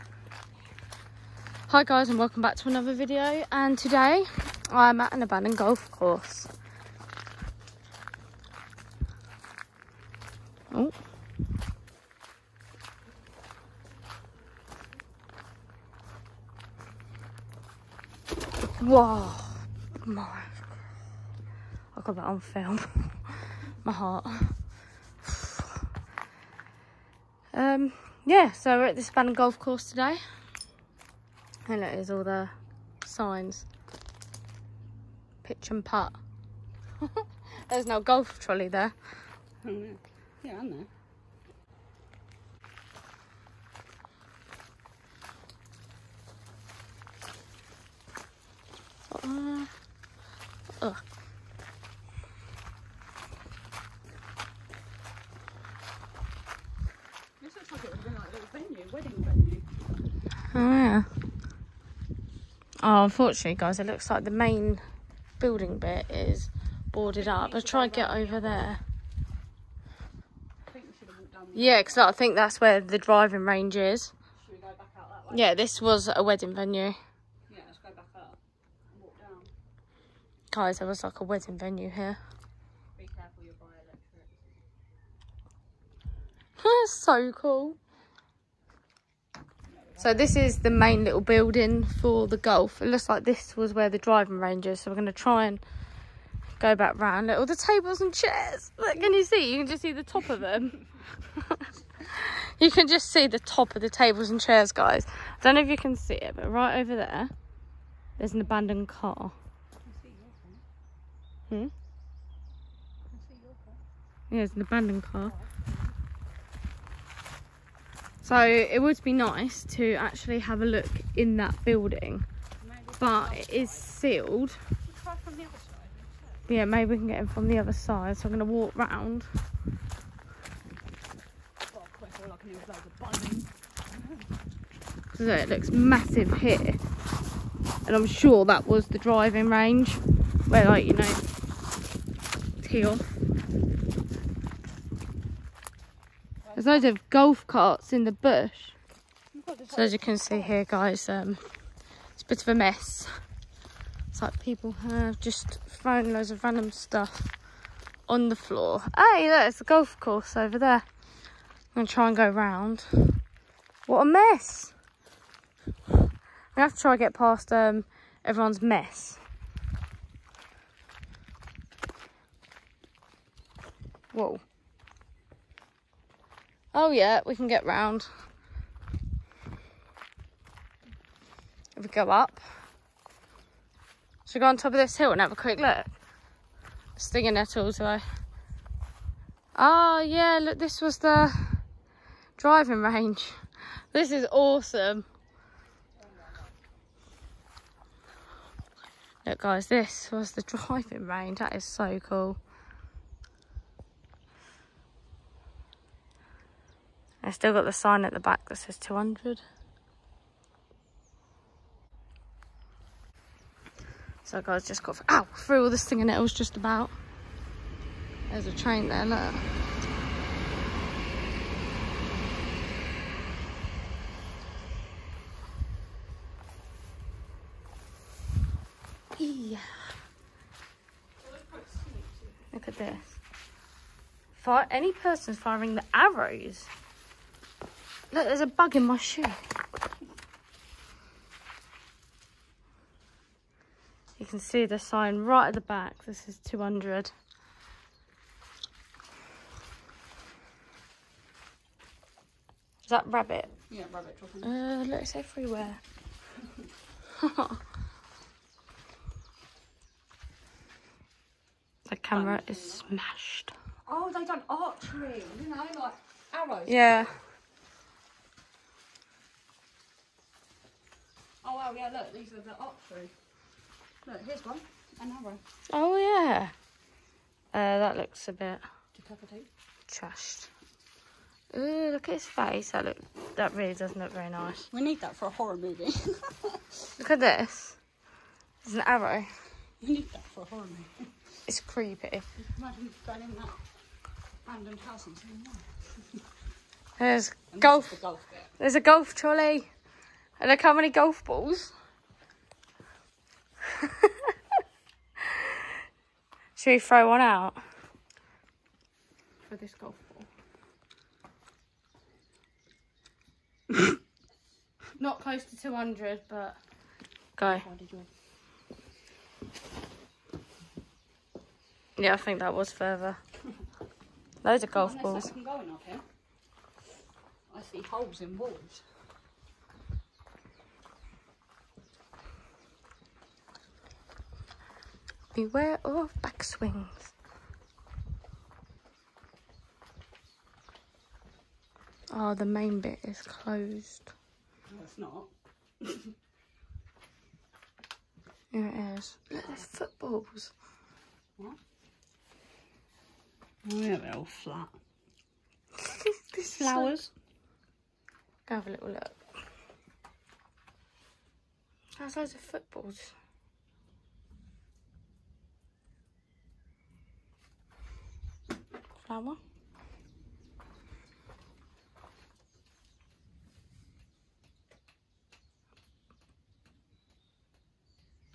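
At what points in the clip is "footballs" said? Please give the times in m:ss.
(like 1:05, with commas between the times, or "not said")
5:49, 6:02.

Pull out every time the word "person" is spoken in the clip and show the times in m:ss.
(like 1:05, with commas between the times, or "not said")
3:54.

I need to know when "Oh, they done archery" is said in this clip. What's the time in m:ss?
4:23.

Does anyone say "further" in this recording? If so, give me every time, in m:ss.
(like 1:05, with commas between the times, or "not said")
5:22.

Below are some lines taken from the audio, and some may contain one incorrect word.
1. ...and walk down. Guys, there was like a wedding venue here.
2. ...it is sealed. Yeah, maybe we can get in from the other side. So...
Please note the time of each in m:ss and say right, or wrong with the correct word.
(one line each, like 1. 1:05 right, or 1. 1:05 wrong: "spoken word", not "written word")
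1. 1:18 right
2. 2:03 right.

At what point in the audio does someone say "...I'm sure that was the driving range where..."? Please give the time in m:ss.
2:17.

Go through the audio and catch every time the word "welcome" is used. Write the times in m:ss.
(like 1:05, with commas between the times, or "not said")
0:02.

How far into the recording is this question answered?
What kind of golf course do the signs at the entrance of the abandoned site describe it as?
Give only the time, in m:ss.
0:35.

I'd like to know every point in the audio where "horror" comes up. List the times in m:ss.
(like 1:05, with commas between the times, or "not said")
4:45, 4:50.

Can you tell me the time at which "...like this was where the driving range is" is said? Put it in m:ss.
1:33.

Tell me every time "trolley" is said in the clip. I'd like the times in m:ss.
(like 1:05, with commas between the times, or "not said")
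0:38, 4:59.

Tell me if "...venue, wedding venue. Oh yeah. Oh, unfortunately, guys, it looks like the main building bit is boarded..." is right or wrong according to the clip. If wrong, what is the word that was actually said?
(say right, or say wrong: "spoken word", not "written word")
right.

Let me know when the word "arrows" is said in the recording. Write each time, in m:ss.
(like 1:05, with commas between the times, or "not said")
3:55, 4:26, 4:48.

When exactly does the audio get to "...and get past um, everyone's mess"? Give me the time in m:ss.
2:46.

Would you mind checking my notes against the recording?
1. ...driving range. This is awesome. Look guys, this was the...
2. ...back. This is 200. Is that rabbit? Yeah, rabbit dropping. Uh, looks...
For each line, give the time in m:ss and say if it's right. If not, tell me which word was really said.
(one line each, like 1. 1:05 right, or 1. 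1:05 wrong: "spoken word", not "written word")
1. 3:12 right
2. 4:05 right.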